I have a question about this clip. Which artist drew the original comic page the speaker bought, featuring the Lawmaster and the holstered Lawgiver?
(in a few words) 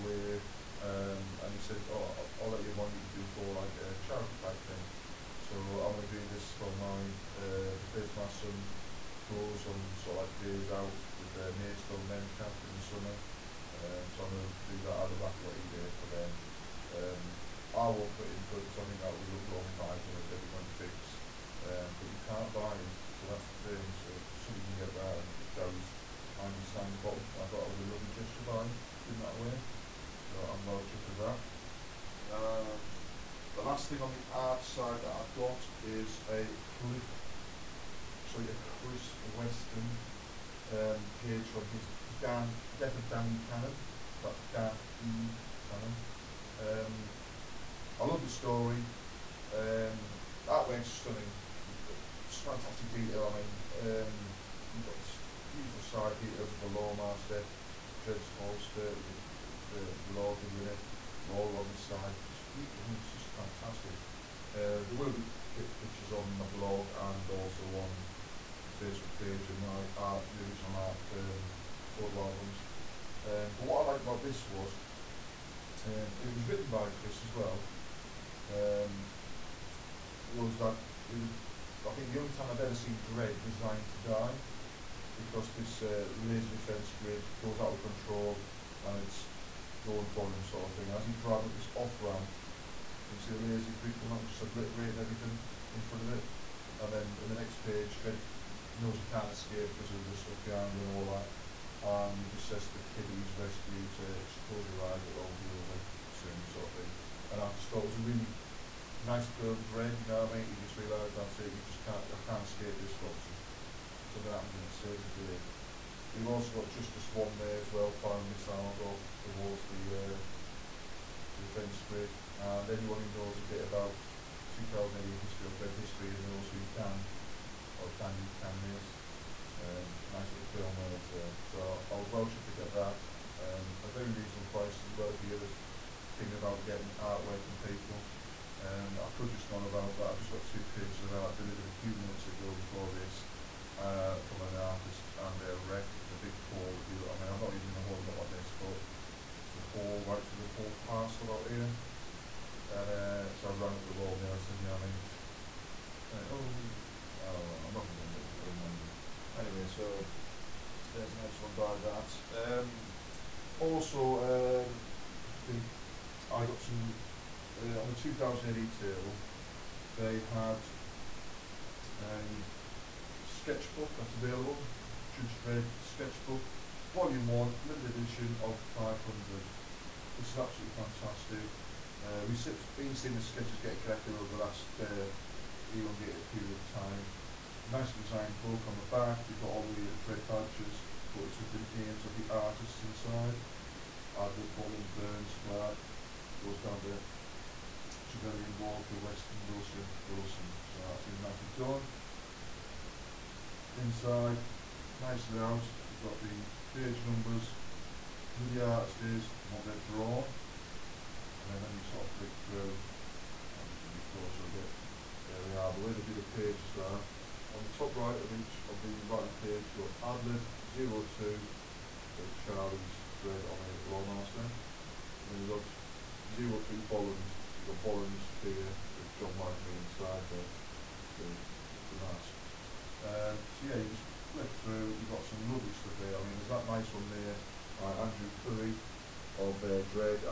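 Chris Weston.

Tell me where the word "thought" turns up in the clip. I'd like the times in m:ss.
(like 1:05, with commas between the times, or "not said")
0:27, 1:47.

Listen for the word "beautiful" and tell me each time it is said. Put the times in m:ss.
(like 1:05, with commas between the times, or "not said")
0:55, 1:02.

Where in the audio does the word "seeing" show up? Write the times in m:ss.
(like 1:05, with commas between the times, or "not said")
3:02.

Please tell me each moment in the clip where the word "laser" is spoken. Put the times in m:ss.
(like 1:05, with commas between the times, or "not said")
1:26, 1:33.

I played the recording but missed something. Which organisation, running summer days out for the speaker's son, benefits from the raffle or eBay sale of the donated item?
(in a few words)
Maidstone Mencap.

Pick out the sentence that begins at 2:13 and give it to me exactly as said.
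Um, a very reasonable price as well if you're just thinking about getting artwork from people.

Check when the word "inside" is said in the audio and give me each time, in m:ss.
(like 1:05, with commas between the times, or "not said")
3:12, 3:23, 3:49.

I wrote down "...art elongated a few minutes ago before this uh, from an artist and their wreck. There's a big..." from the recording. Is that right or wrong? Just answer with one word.
wrong.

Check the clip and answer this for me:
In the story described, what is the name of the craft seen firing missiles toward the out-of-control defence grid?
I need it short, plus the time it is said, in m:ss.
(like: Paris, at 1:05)
Justice One, at 1:56.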